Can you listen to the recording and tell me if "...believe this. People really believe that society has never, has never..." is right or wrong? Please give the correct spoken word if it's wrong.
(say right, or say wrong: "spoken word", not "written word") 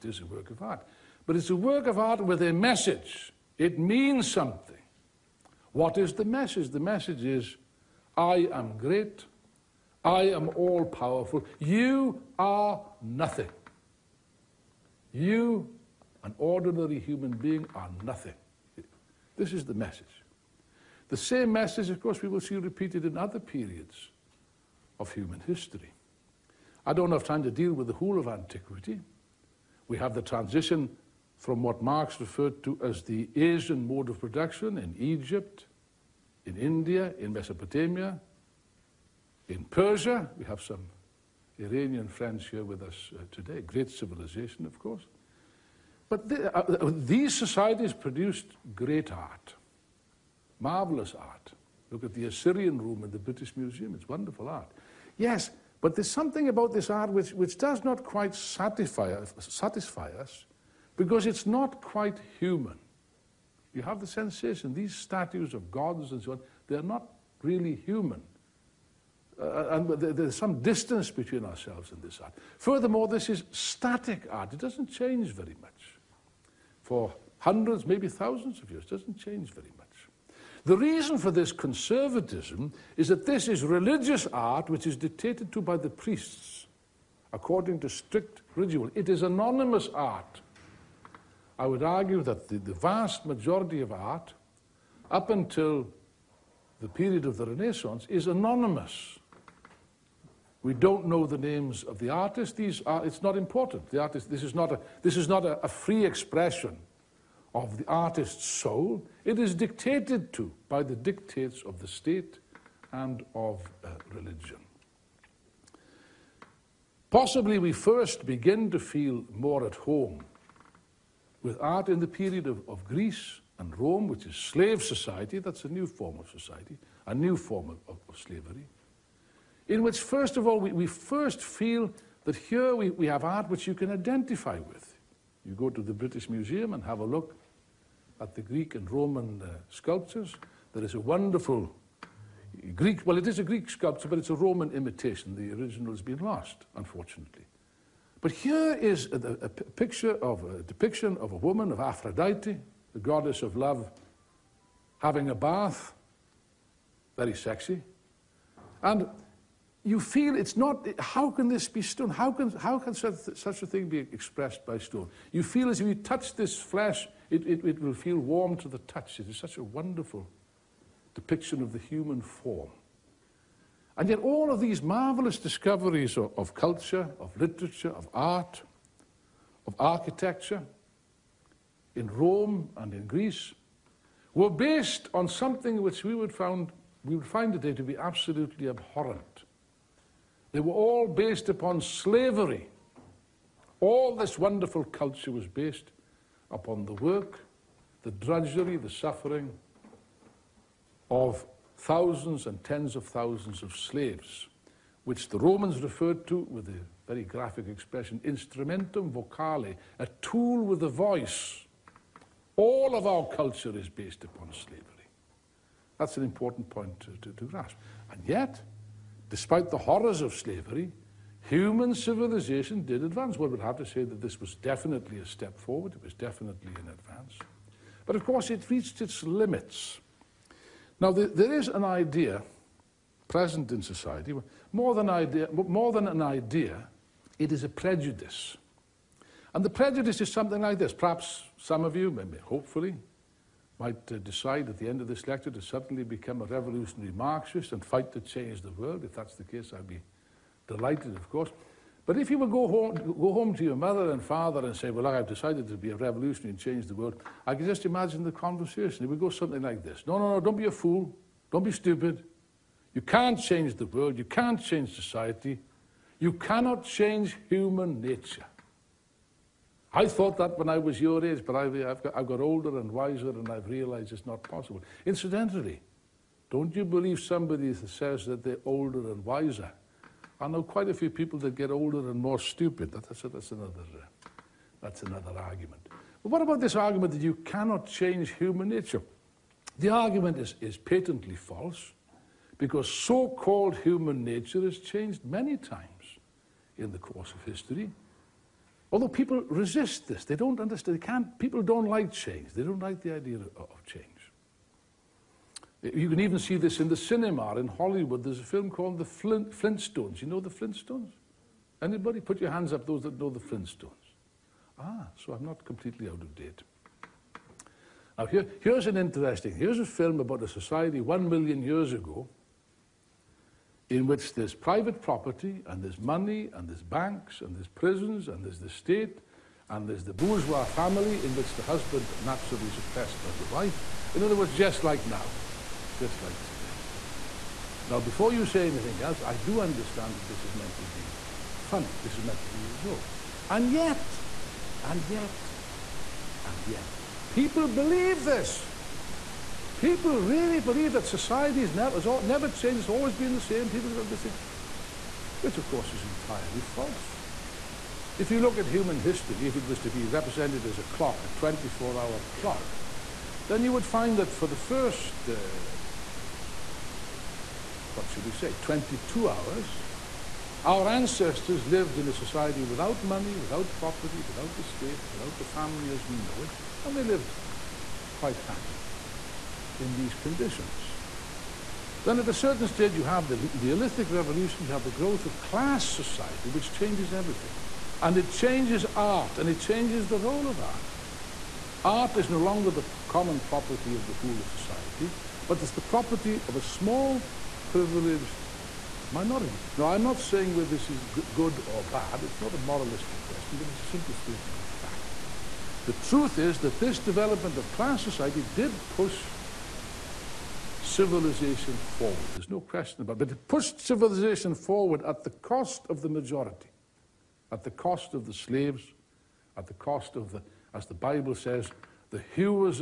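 right.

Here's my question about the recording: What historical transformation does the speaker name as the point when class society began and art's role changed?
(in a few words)
Neolithic Revolution.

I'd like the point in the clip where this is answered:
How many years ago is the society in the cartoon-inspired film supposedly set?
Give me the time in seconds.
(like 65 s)
321 s.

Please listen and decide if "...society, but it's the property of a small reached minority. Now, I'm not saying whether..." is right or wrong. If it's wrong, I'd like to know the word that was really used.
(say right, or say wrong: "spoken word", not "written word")
wrong: "privileged", not "reached".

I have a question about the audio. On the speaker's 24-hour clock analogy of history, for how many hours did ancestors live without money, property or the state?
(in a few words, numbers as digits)
22 hours.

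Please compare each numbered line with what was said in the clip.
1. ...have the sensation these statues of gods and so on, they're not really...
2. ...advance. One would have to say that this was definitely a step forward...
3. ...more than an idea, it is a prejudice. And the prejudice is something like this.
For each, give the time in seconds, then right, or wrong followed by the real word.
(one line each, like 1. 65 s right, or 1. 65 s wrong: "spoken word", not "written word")
1. 63 s right
2. 223 s right
3. 235 s right.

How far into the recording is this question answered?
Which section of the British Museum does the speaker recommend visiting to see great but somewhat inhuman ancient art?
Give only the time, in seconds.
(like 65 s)
52 s.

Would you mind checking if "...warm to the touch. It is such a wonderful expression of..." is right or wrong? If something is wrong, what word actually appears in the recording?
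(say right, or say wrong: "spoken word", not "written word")
wrong: "depiction", not "expression".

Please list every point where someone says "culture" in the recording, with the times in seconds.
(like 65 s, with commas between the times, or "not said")
176 s, 194 s, 213 s.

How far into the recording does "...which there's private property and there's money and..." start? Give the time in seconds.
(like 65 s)
324 s.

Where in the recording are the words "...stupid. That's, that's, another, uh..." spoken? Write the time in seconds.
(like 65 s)
282 s.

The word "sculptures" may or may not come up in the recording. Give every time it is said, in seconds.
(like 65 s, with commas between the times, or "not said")
139 s, 143 s.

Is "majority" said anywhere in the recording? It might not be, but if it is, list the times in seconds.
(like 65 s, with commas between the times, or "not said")
93 s, 416 s.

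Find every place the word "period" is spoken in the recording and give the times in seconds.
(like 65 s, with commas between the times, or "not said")
23 s, 96 s, 122 s.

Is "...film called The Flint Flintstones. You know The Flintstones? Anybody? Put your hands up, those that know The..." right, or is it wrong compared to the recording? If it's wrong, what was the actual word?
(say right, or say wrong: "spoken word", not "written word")
right.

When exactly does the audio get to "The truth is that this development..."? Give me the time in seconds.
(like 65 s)
405 s.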